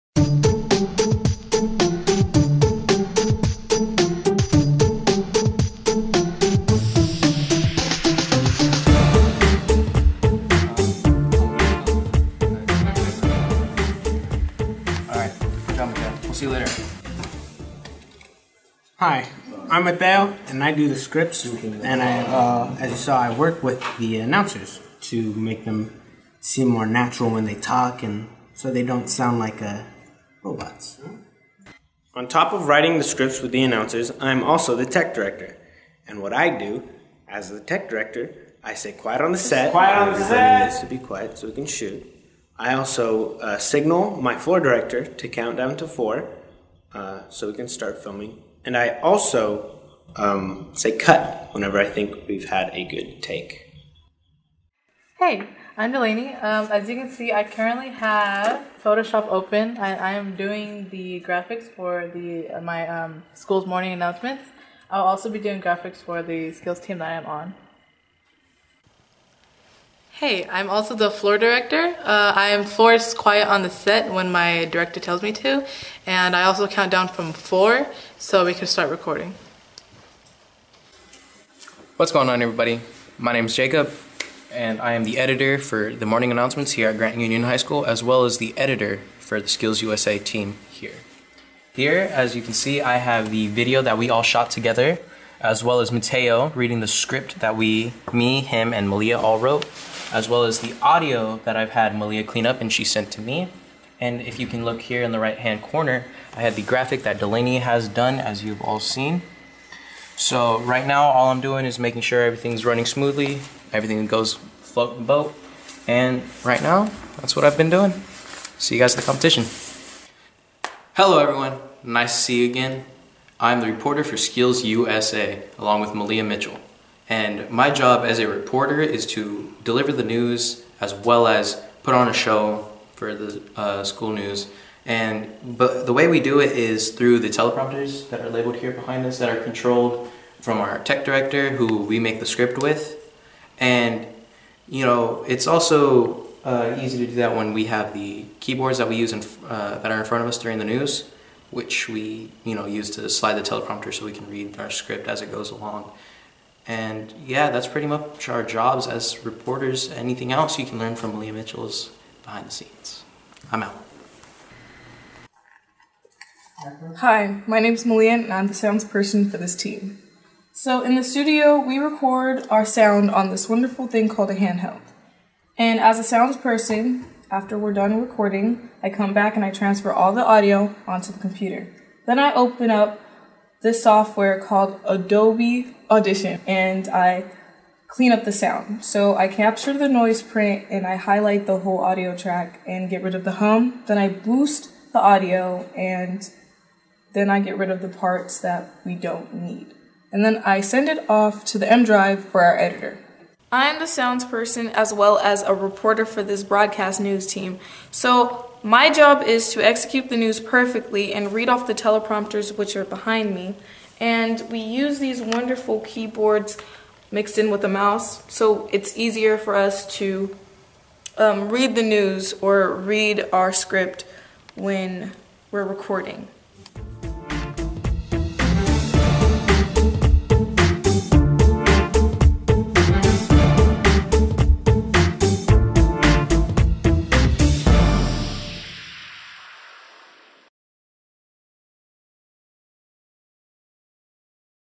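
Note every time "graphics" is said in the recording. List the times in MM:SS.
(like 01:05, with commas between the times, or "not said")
01:01, 01:05, 01:46.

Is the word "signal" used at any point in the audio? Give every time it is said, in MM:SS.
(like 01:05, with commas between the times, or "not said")
00:43.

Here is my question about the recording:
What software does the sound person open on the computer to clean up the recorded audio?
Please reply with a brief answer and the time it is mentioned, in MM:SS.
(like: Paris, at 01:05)
Adobe Audition, at 03:04.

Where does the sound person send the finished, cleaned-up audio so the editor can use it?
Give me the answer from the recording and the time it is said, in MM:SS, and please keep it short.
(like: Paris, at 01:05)
M drive, at 03:21.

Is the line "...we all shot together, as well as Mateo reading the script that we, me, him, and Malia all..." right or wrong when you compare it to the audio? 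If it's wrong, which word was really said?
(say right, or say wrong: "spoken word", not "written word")
right.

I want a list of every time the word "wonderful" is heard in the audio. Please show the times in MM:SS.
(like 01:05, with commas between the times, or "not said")
02:53, 03:35.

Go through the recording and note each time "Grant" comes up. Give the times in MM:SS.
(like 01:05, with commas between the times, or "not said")
01:26.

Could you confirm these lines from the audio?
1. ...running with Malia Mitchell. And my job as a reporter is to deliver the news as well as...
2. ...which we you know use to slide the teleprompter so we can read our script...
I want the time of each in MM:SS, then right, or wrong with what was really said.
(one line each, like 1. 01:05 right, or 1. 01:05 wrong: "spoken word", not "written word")
1. 02:05 wrong: "along", not "running"
2. 02:31 right.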